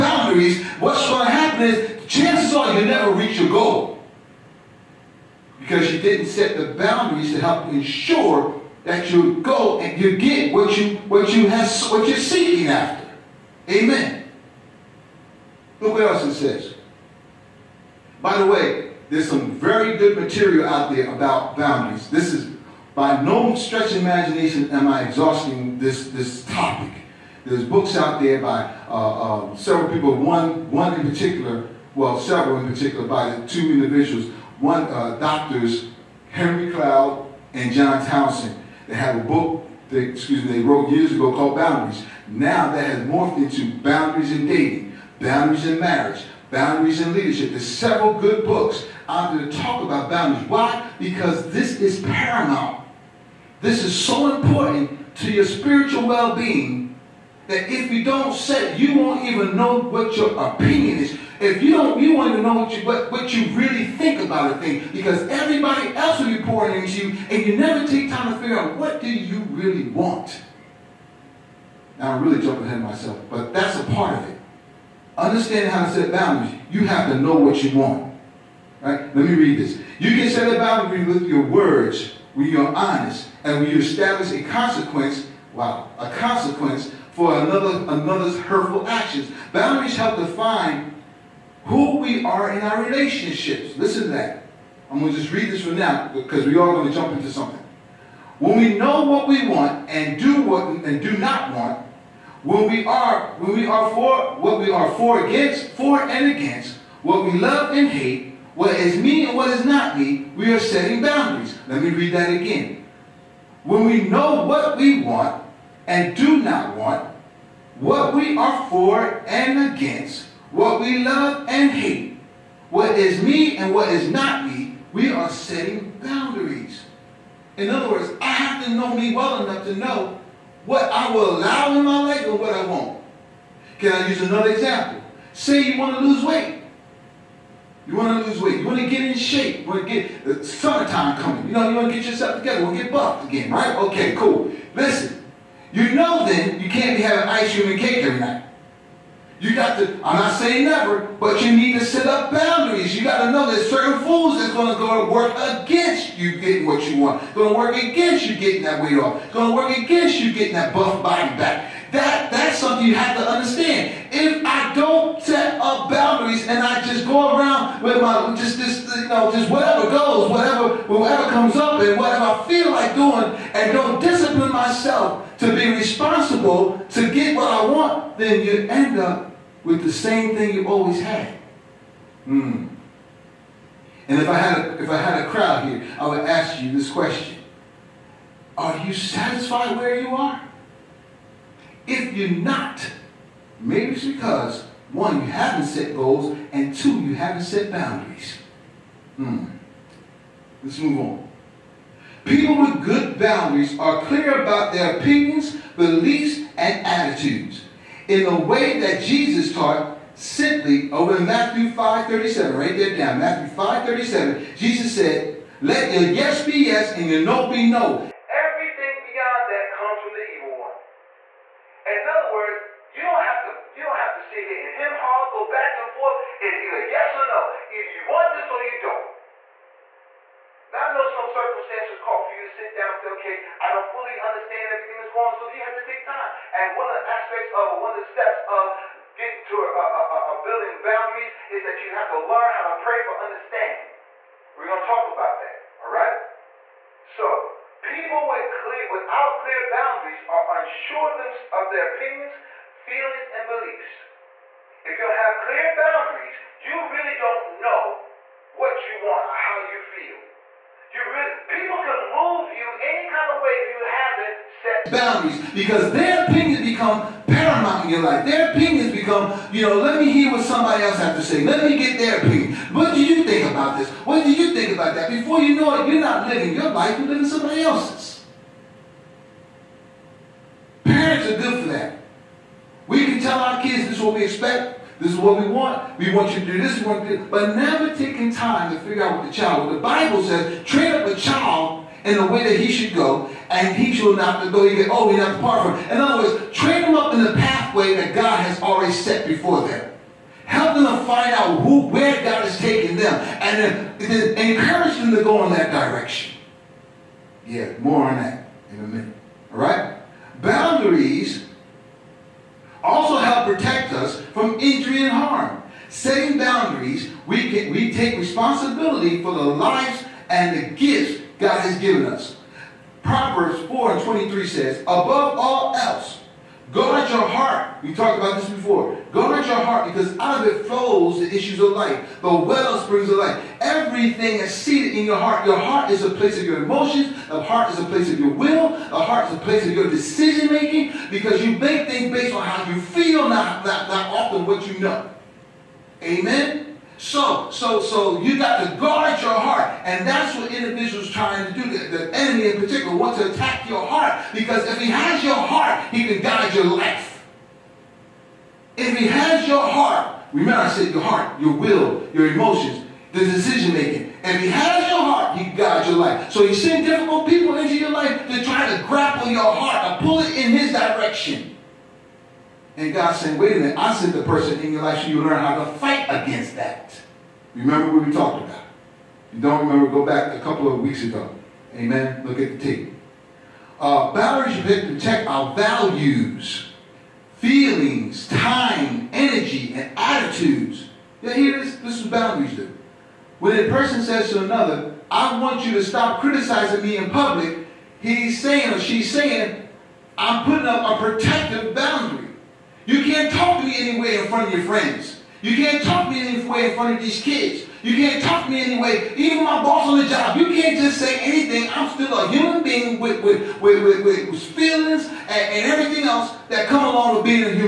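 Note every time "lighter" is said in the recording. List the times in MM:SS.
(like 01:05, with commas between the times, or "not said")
not said.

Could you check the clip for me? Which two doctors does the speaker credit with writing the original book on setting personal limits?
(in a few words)
Henry Cloud and John Townsend.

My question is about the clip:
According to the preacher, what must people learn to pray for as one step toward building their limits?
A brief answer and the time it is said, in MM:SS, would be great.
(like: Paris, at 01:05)
understanding, at 04:03.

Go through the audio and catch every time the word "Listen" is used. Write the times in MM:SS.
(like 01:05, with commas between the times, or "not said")
01:33, 02:24.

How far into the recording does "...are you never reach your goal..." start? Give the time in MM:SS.
00:02.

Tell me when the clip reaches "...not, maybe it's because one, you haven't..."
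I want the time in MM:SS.
03:12.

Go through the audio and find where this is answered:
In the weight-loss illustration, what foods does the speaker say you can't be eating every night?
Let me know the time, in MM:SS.
02:27.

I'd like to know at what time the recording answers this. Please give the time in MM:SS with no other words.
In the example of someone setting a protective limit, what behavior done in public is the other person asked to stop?
06:36.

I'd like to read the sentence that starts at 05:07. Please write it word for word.
Yeah, more on that in a minute.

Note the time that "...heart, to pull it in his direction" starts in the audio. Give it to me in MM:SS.
06:09.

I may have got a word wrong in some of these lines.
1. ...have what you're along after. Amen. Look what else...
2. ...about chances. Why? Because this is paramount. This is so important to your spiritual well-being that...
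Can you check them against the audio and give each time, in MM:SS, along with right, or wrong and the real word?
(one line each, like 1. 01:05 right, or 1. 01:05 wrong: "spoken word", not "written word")
1. 00:11 wrong: "seeking", not "along"
2. 00:49 wrong: "boundaries", not "chances".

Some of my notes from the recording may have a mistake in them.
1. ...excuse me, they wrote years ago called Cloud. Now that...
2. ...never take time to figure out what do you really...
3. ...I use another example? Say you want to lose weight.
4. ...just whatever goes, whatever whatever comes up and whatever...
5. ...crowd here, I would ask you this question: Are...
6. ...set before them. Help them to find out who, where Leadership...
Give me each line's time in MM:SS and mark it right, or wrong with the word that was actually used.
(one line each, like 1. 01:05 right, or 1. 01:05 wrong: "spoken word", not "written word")
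1. 00:40 wrong: "Boundaries", not "Cloud"
2. 01:07 right
3. 02:13 right
4. 02:49 right
5. 03:05 right
6. 04:58 wrong: "God", not "Leadership".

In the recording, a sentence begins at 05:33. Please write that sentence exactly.
Everything is seated in your heart.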